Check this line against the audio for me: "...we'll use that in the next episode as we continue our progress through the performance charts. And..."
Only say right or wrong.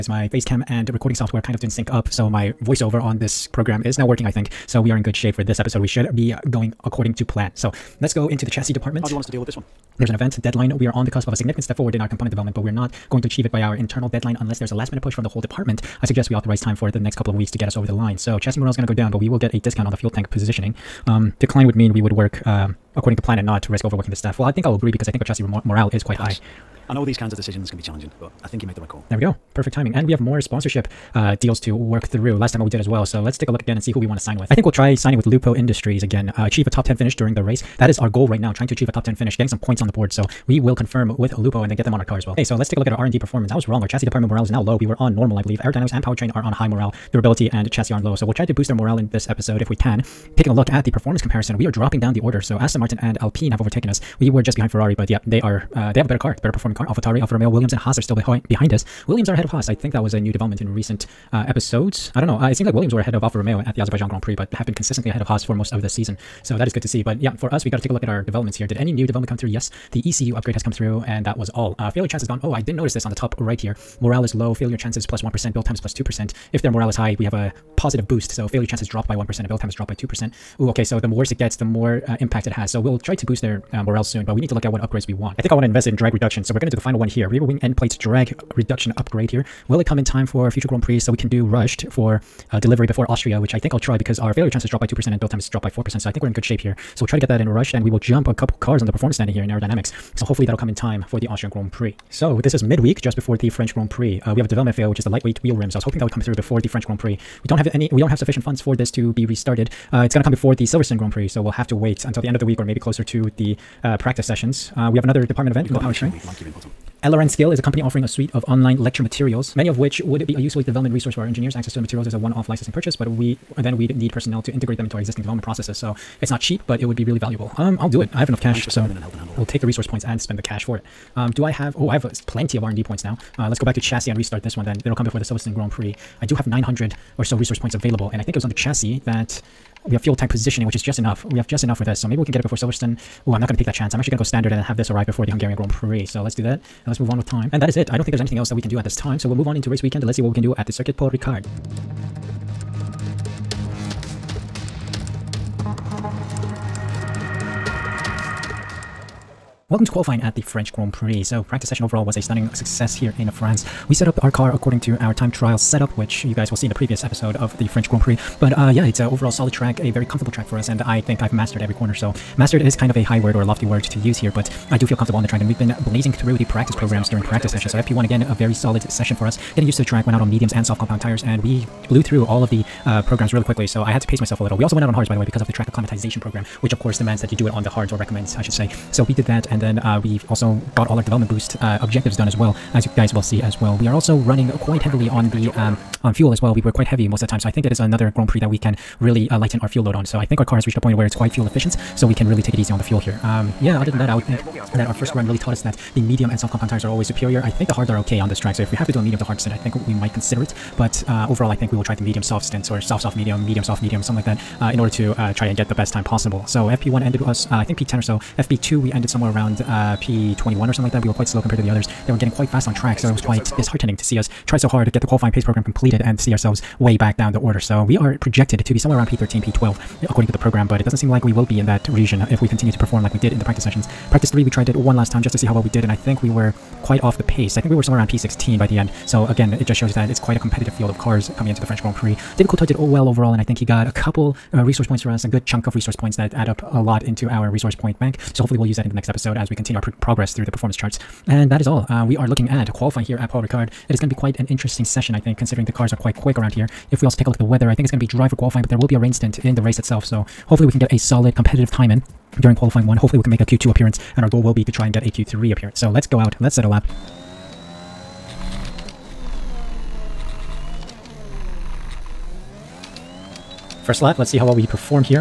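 right.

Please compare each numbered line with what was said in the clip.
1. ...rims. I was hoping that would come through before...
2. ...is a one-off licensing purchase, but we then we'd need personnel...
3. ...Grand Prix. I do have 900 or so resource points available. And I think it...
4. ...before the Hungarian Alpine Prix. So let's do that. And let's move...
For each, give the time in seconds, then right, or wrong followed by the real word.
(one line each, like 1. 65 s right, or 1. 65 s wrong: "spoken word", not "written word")
1. 105 s right
2. 122 s right
3. 135 s right
4. 145 s wrong: "Grand", not "Alpine".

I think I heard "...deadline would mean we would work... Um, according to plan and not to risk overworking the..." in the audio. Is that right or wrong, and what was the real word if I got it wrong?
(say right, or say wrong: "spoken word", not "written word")
wrong: "decline", not "deadline".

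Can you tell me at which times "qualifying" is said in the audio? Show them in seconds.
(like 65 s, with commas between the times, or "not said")
159 s, 225 s, 252 s, 258 s, 262 s.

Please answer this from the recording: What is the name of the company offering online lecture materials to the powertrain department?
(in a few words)
LRN Skill.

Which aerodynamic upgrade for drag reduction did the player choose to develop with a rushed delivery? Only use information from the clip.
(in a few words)
Rear wing end plates.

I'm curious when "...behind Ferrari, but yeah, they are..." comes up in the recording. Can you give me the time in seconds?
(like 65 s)
54 s.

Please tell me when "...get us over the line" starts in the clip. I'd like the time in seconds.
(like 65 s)
17 s.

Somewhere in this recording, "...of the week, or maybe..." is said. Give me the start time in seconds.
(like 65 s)
112 s.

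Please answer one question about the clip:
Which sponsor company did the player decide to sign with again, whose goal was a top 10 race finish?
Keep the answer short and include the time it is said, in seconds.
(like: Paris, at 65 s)
Lupo Industries, at 35 s.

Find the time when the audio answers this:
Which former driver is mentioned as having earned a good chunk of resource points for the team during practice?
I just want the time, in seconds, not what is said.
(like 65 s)
242 s.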